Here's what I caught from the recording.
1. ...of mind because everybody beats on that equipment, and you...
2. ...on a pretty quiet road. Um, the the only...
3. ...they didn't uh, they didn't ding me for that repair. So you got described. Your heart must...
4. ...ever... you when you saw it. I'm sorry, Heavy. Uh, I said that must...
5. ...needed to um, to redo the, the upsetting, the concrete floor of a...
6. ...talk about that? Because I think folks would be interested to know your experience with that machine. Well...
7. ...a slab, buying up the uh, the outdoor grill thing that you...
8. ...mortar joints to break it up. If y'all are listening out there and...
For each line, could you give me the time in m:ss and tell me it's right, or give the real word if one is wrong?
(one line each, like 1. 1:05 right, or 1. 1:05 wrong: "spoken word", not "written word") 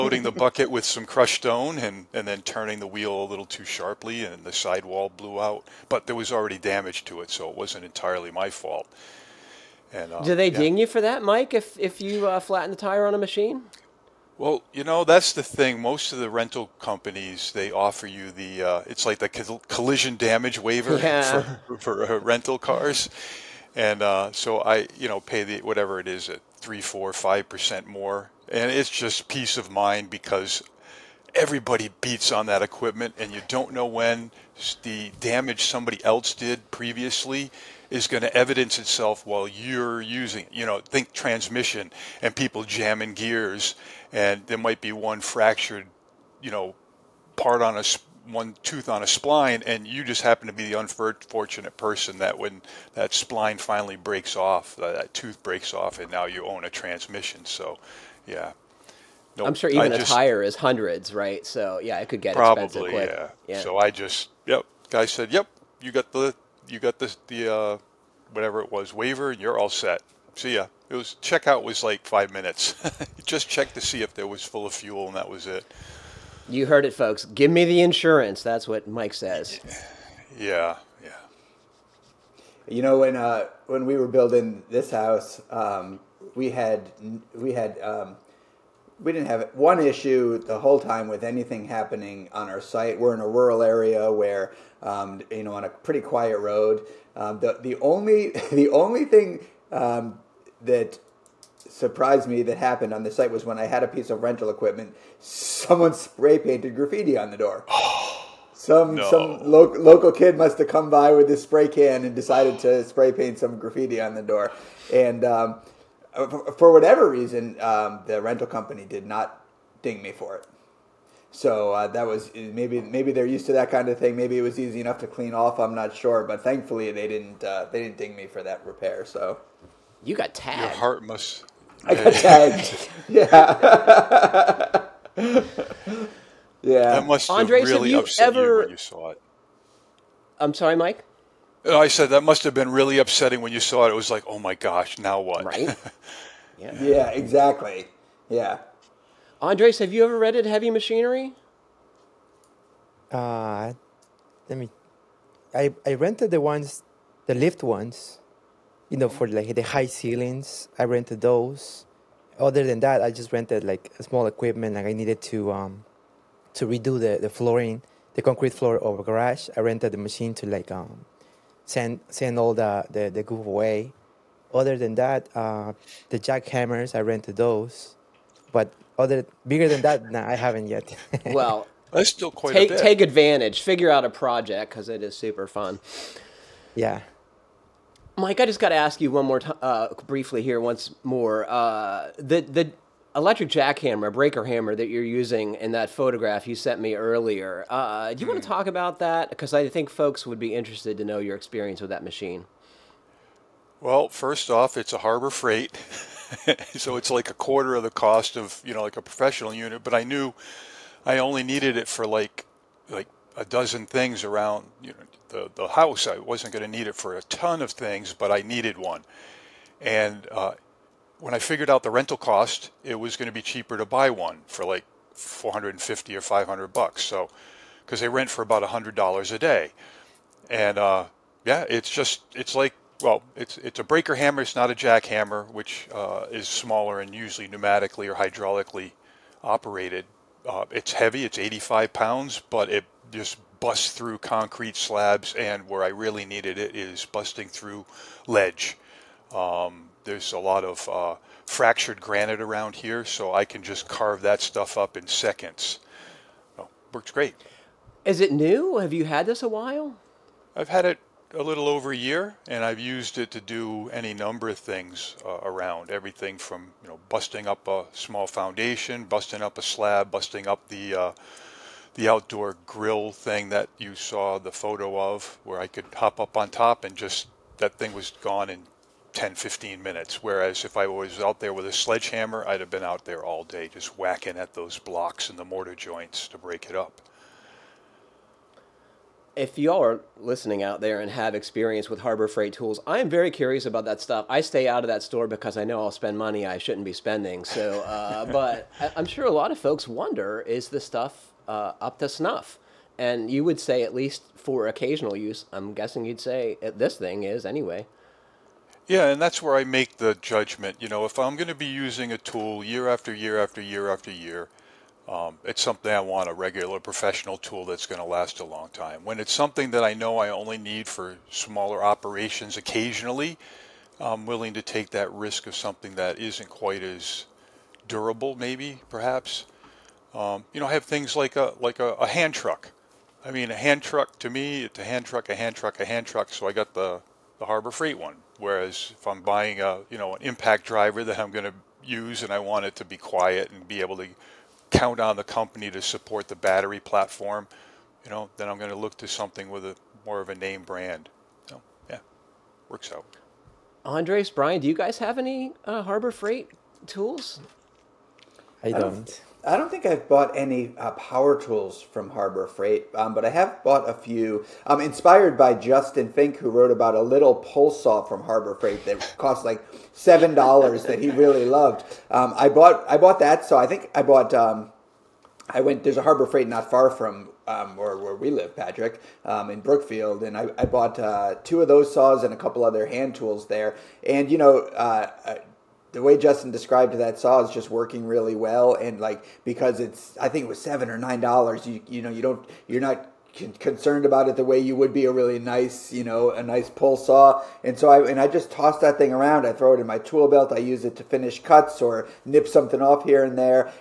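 1. 0:29 right
2. 1:35 right
3. 2:06 wrong: "tagged", not "described"
4. 2:18 wrong: "Mike", not "Heavy"
5. 2:44 wrong: "flooring", not "upsetting"
6. 3:18 right
7. 4:29 wrong: "busting", not "buying"
8. 4:45 right.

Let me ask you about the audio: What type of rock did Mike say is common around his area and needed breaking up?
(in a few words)
fractured granite.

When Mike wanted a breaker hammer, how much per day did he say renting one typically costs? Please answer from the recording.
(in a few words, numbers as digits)
$100.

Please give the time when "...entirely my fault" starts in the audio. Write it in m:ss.
0:07.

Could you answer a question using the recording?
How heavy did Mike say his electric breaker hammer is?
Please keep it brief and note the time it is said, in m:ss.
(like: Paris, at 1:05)
85 pounds, at 4:01.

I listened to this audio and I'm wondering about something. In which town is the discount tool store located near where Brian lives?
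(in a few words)
Brookfield.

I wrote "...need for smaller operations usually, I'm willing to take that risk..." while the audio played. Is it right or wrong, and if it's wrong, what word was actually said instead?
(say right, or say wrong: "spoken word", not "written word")
wrong: "occasionally", not "usually".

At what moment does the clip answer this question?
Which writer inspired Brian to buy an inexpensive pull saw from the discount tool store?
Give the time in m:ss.
6:05.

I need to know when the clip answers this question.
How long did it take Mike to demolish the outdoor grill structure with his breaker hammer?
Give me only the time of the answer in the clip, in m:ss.
4:39.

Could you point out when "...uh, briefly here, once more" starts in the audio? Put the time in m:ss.
3:09.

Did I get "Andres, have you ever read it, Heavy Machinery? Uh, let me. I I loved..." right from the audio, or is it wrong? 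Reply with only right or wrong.
wrong.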